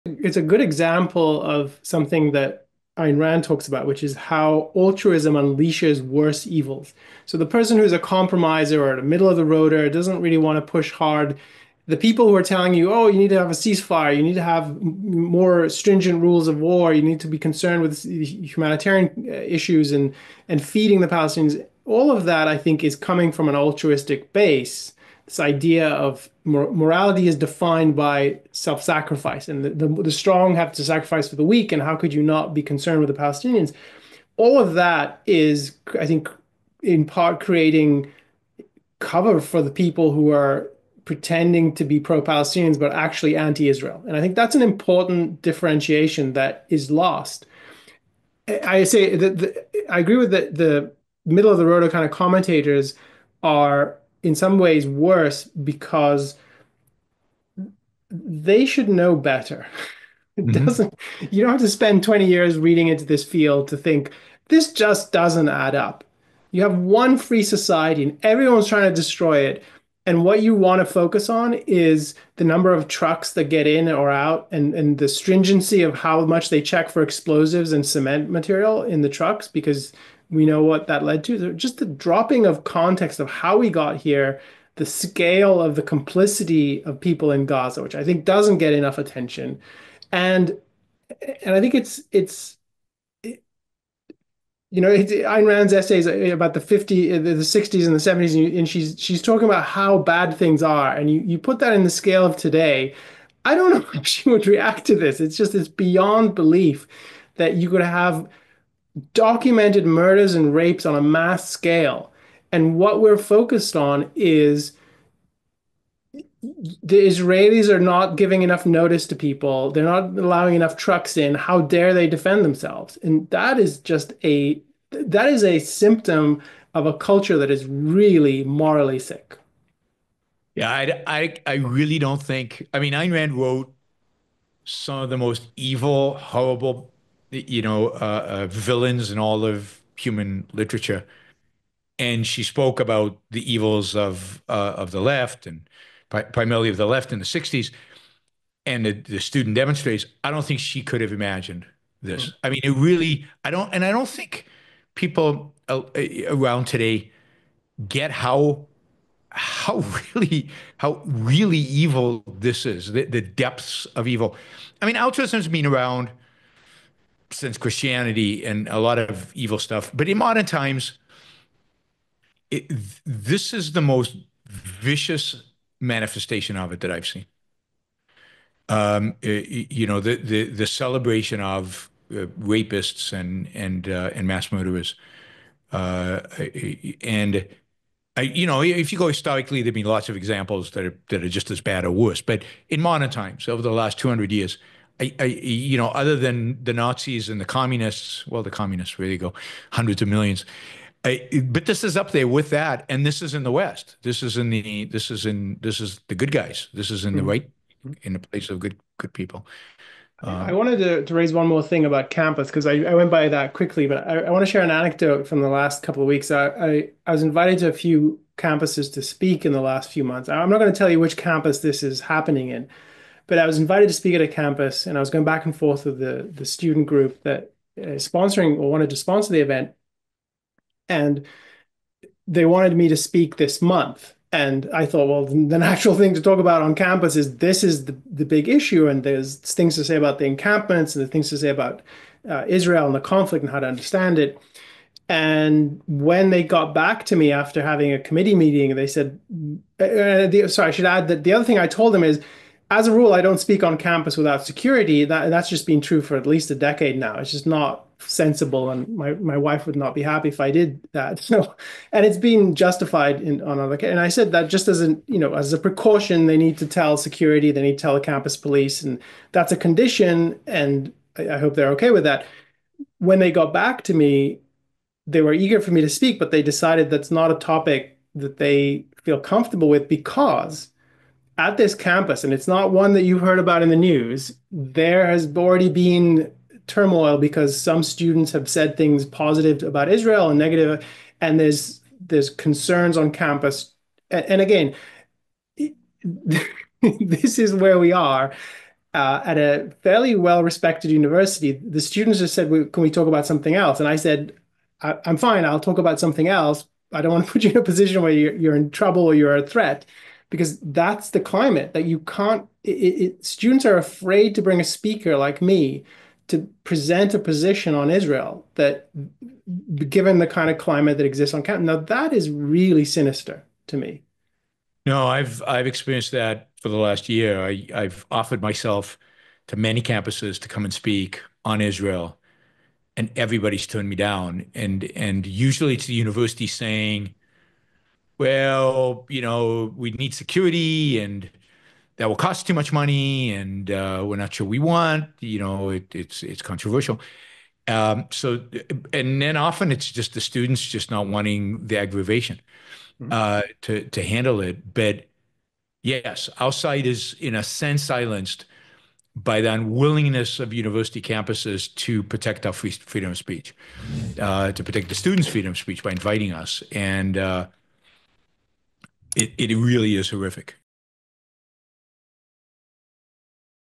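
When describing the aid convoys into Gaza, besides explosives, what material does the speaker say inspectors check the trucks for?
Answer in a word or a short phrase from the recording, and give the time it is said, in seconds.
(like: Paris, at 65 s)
cement, at 77 s.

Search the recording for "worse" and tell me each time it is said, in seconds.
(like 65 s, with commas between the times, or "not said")
6 s, 54 s, 191 s.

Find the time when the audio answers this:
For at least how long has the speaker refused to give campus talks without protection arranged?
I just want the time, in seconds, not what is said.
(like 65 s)
256 s.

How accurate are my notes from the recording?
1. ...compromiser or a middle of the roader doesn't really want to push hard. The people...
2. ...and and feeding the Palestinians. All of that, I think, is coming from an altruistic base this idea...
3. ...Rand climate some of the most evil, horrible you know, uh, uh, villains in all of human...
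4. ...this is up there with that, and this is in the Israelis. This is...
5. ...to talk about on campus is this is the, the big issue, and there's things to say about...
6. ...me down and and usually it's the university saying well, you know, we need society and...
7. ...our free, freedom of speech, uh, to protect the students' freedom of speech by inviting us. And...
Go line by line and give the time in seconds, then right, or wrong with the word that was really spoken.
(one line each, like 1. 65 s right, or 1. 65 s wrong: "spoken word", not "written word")
1. 7 s right
2. 19 s right
3. 133 s wrong: "wrote", not "climate"
4. 201 s wrong: "West", not "Israelis"
5. 236 s right
6. 333 s wrong: "security", not "society"
7. 362 s right.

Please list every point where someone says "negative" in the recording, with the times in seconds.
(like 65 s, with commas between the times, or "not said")
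290 s.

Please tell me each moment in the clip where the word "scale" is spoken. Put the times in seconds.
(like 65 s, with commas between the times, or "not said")
84 s, 101 s, 111 s.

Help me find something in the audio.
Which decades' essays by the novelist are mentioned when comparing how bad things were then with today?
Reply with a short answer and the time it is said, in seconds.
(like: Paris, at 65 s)
the 60s and the 70s, at 97 s.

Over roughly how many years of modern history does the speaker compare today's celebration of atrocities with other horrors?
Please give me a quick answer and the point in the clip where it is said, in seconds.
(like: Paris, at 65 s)
200 years, at 193 s.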